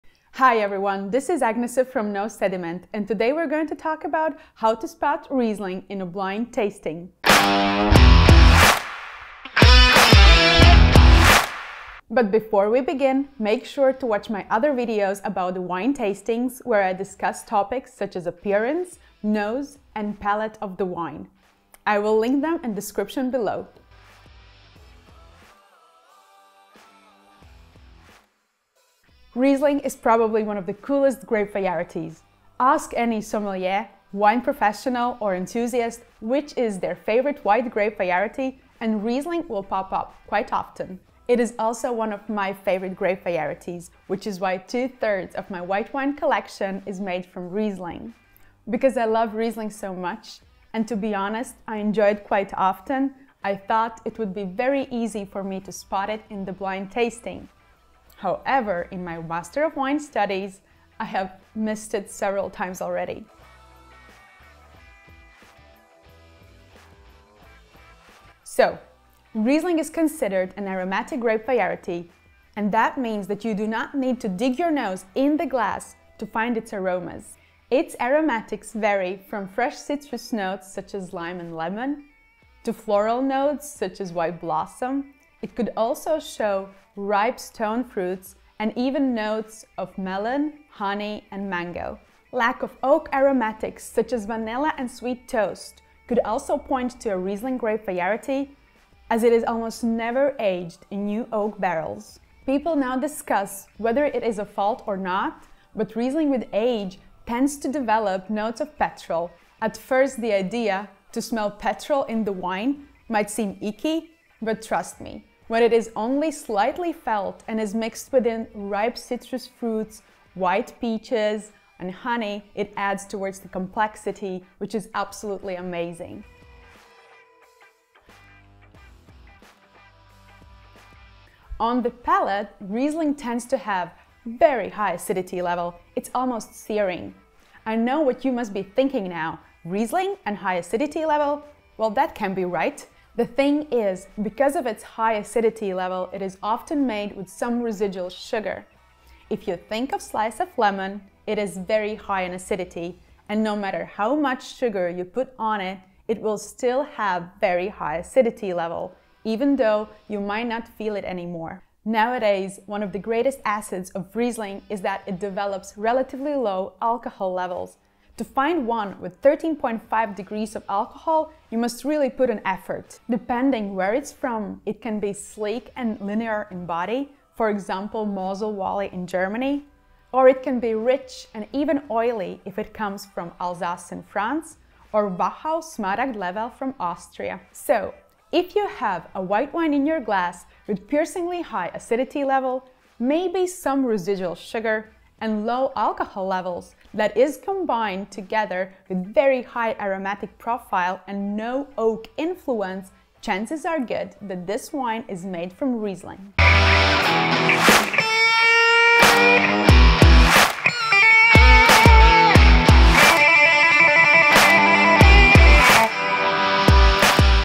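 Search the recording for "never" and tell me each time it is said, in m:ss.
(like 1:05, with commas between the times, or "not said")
1:39.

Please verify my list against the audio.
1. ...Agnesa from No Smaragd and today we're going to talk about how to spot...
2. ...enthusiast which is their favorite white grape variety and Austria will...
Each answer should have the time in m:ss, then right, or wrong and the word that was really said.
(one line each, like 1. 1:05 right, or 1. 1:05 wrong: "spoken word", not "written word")
1. 0:01 wrong: "Sediment", not "Smaragd"
2. 0:35 wrong: "Riesling", not "Austria".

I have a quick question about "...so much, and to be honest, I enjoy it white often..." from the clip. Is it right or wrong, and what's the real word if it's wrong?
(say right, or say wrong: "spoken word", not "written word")
wrong: "quite", not "white".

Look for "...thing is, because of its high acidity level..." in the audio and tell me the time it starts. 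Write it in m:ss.
2:23.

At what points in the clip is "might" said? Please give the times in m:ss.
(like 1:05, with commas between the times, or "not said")
1:53, 2:40.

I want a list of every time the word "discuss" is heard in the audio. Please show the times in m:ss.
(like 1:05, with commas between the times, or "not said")
0:16, 1:42.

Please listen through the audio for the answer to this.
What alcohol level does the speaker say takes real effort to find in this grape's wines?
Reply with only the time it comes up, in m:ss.
2:49.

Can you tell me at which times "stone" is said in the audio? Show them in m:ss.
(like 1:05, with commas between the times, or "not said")
1:27.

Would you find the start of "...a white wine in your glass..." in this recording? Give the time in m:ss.
3:09.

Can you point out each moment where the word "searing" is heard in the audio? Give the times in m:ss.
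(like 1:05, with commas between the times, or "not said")
2:16.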